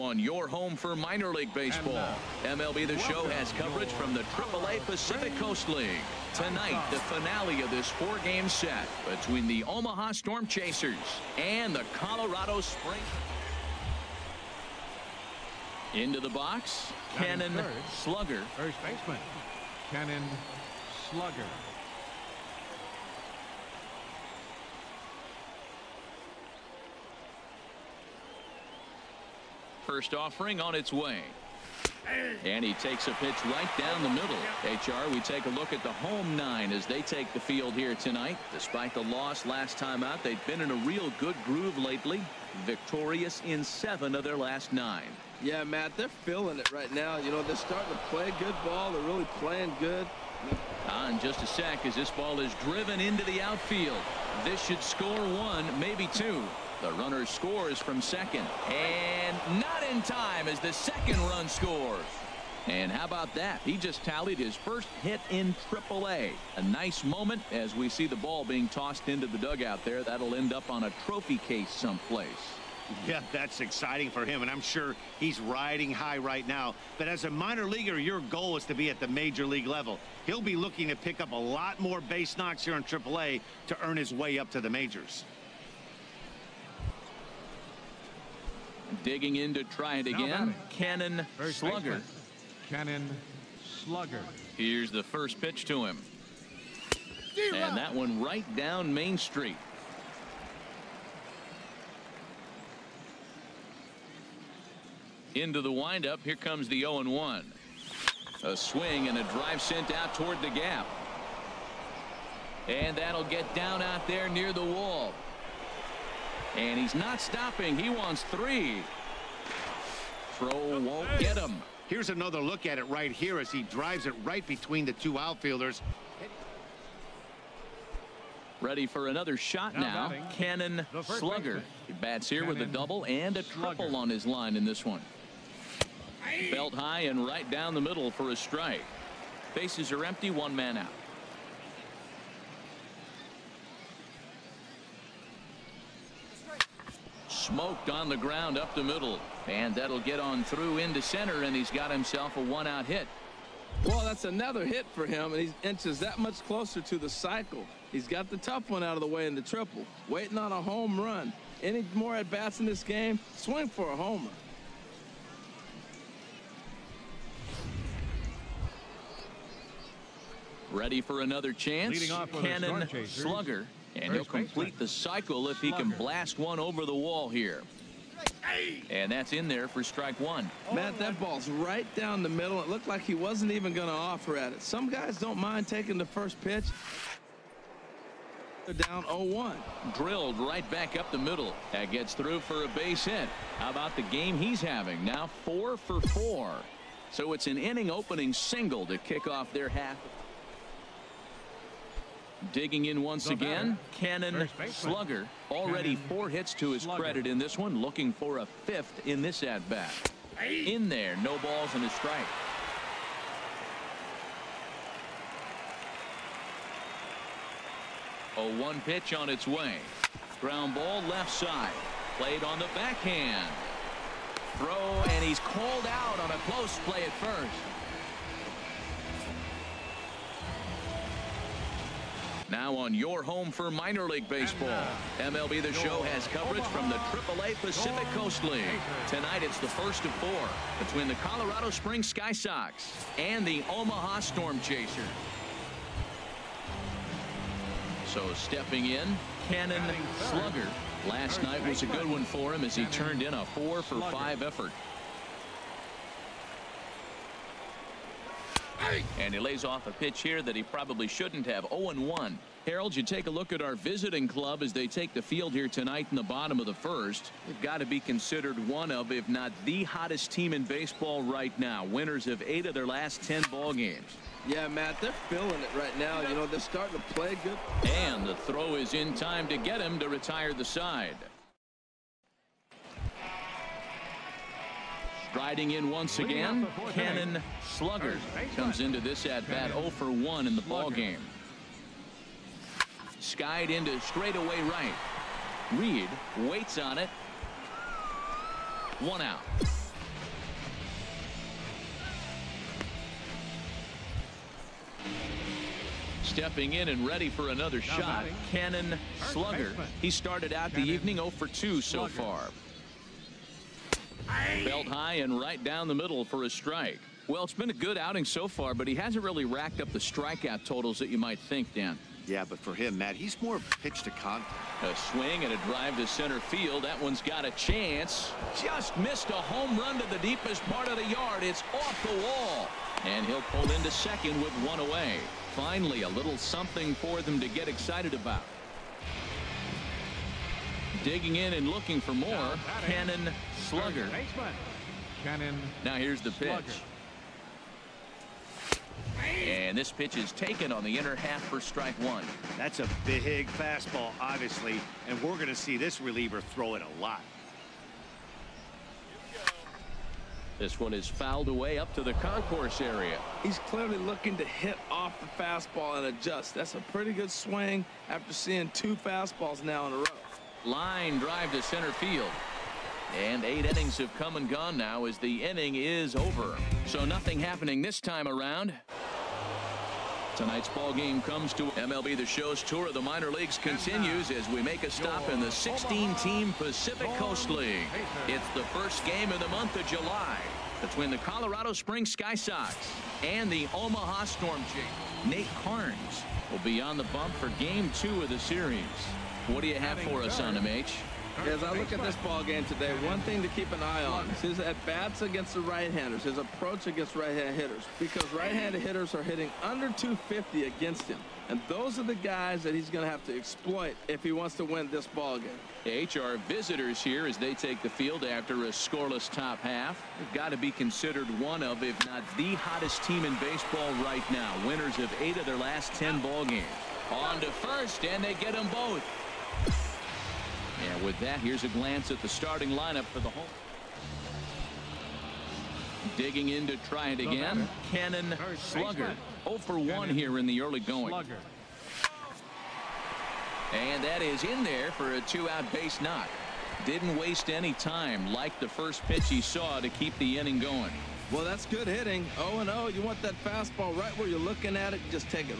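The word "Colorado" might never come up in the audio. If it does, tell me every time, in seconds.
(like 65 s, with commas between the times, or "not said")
11 s, 241 s, 391 s.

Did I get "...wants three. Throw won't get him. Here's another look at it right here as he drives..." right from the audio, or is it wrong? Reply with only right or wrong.
right.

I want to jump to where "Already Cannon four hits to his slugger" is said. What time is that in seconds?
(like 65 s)
205 s.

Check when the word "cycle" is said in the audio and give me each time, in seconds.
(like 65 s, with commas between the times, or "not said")
157 s, 174 s.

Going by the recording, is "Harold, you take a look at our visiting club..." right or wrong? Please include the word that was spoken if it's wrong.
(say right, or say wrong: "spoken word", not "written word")
right.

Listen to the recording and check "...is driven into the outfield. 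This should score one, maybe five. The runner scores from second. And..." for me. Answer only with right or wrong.
wrong.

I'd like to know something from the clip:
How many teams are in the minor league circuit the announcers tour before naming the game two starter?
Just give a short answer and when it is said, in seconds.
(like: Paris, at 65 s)
16, at 385 s.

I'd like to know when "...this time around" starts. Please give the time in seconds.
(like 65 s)
377 s.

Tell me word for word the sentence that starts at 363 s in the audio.
He's clearly looking to hit off the fastball and adjust.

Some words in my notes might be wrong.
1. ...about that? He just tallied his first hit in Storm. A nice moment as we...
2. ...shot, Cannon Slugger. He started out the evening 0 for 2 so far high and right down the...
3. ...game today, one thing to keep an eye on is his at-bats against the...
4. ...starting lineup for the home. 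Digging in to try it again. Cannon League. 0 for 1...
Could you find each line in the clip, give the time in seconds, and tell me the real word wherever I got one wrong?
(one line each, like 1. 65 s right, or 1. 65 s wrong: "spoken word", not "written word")
1. 63 s wrong: "AAA", not "Storm"
2. 307 s right
3. 402 s right
4. 432 s wrong: "Slugger", not "League".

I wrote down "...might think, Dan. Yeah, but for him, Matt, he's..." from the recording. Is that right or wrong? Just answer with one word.
right.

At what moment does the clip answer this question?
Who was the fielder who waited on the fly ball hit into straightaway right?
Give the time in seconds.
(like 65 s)
295 s.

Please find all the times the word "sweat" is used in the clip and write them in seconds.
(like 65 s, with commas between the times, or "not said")
not said.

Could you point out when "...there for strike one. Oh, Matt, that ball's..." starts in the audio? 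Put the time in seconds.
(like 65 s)
179 s.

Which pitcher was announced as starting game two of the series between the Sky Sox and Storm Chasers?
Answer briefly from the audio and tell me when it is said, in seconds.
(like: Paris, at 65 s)
Nate Carnes, at 395 s.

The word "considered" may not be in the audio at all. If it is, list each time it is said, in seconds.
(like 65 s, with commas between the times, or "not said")
267 s, 420 s.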